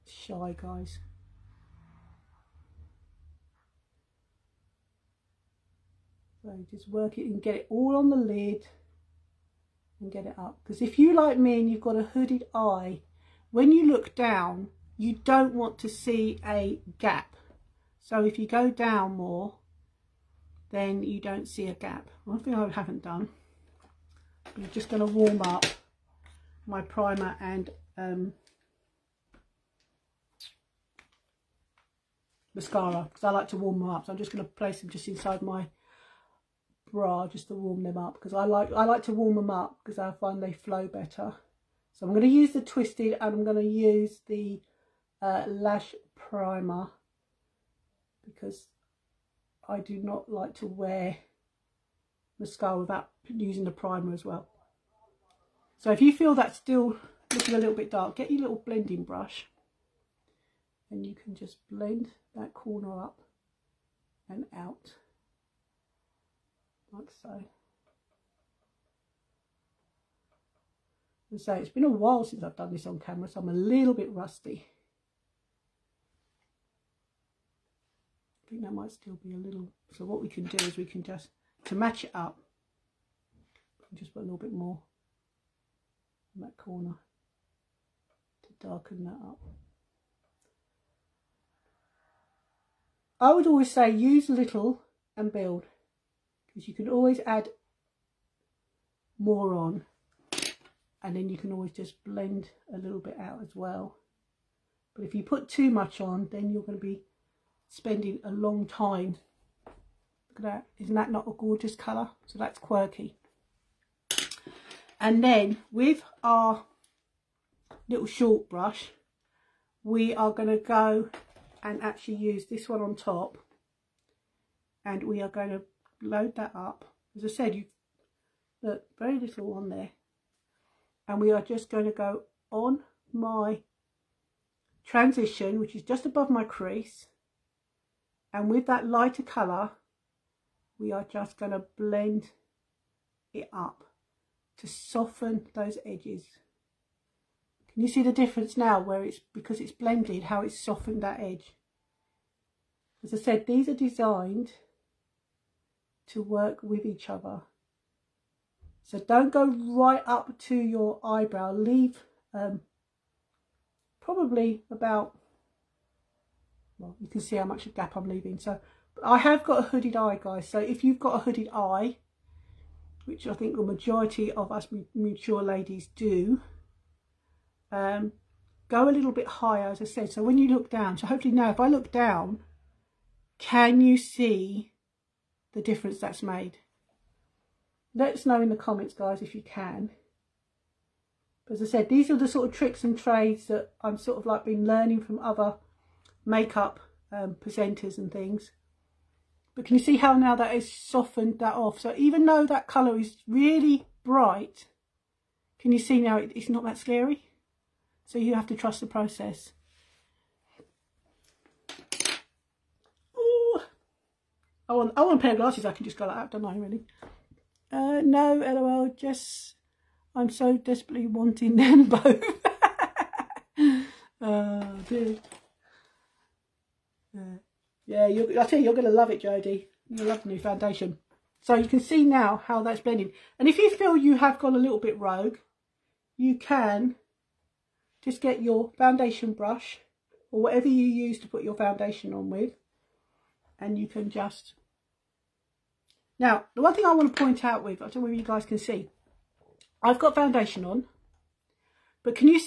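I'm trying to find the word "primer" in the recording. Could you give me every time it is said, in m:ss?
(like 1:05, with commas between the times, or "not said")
0:26, 0:46, 0:53.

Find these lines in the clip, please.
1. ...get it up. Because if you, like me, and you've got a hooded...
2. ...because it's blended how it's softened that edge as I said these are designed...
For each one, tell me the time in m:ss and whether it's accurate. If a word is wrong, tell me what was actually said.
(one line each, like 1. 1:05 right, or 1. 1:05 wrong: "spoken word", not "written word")
1. 0:10 right
2. 2:29 right.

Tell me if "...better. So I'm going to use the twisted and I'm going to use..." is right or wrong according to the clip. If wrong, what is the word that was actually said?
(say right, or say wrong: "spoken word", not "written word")
right.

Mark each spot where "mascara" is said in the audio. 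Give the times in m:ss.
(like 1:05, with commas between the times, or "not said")
0:32, 0:52.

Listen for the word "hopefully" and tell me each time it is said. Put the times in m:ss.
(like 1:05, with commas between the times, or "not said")
3:01.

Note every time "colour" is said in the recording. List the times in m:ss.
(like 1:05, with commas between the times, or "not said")
1:51, 2:19, 3:22.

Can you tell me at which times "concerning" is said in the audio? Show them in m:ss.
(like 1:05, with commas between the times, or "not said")
not said.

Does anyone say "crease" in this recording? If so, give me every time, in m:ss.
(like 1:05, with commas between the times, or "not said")
2:16.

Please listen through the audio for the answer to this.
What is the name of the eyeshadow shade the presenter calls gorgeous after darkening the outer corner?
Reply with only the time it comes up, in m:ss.
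1:52.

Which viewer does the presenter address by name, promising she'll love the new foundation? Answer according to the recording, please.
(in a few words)
Jodie.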